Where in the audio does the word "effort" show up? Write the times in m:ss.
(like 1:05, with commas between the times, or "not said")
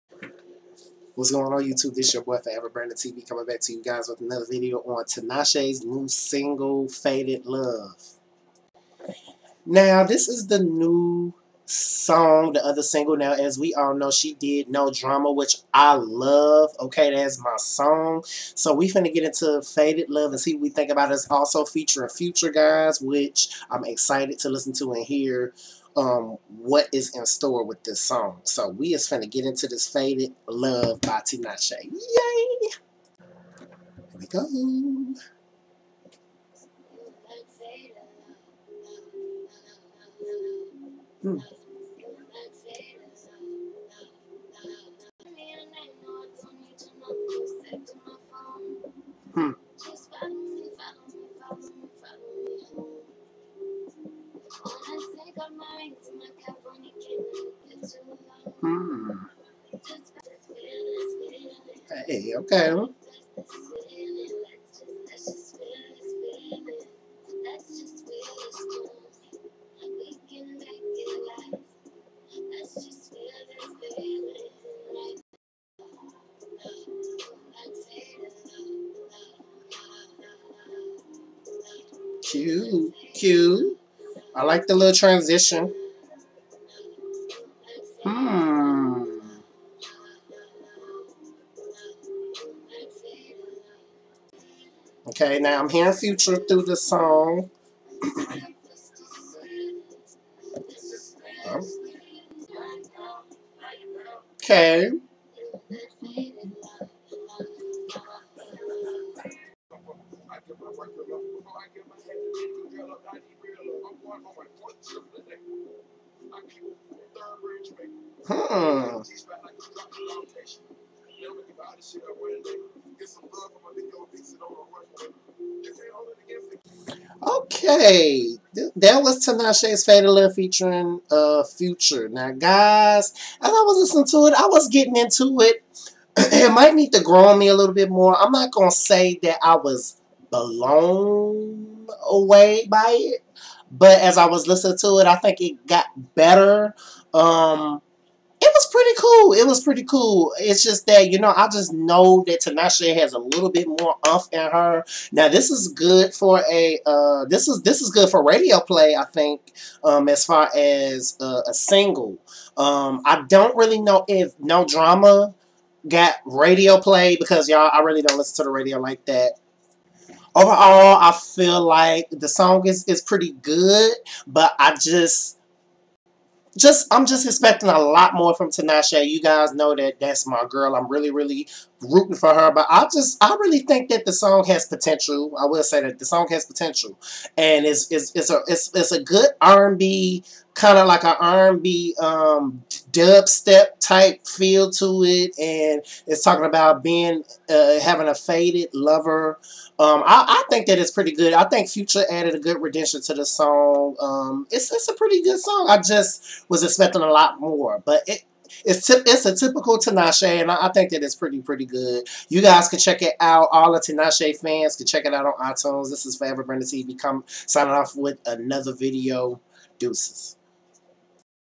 not said.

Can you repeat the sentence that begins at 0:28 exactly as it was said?
So we is finna get into this Faded Love by Tinashe.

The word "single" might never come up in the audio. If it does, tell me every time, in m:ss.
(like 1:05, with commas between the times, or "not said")
0:06, 0:12, 2:41.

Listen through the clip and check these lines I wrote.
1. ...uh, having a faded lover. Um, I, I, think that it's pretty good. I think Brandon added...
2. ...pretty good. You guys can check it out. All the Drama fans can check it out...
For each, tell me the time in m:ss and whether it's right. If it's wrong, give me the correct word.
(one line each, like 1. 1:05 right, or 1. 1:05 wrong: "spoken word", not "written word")
1. 3:17 wrong: "Future", not "Brandon"
2. 3:31 wrong: "Tinashe", not "Drama".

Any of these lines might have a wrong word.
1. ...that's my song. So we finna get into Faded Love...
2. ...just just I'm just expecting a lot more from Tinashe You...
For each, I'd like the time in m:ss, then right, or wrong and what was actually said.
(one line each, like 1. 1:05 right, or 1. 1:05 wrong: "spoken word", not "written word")
1. 0:17 right
2. 2:54 right.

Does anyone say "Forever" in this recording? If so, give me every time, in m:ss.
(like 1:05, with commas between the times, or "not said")
0:02, 3:36.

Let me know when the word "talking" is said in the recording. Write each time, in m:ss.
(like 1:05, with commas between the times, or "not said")
3:16.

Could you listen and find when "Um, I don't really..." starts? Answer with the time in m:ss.
2:42.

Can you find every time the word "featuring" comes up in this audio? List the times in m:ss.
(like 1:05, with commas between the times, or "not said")
0:21, 2:10.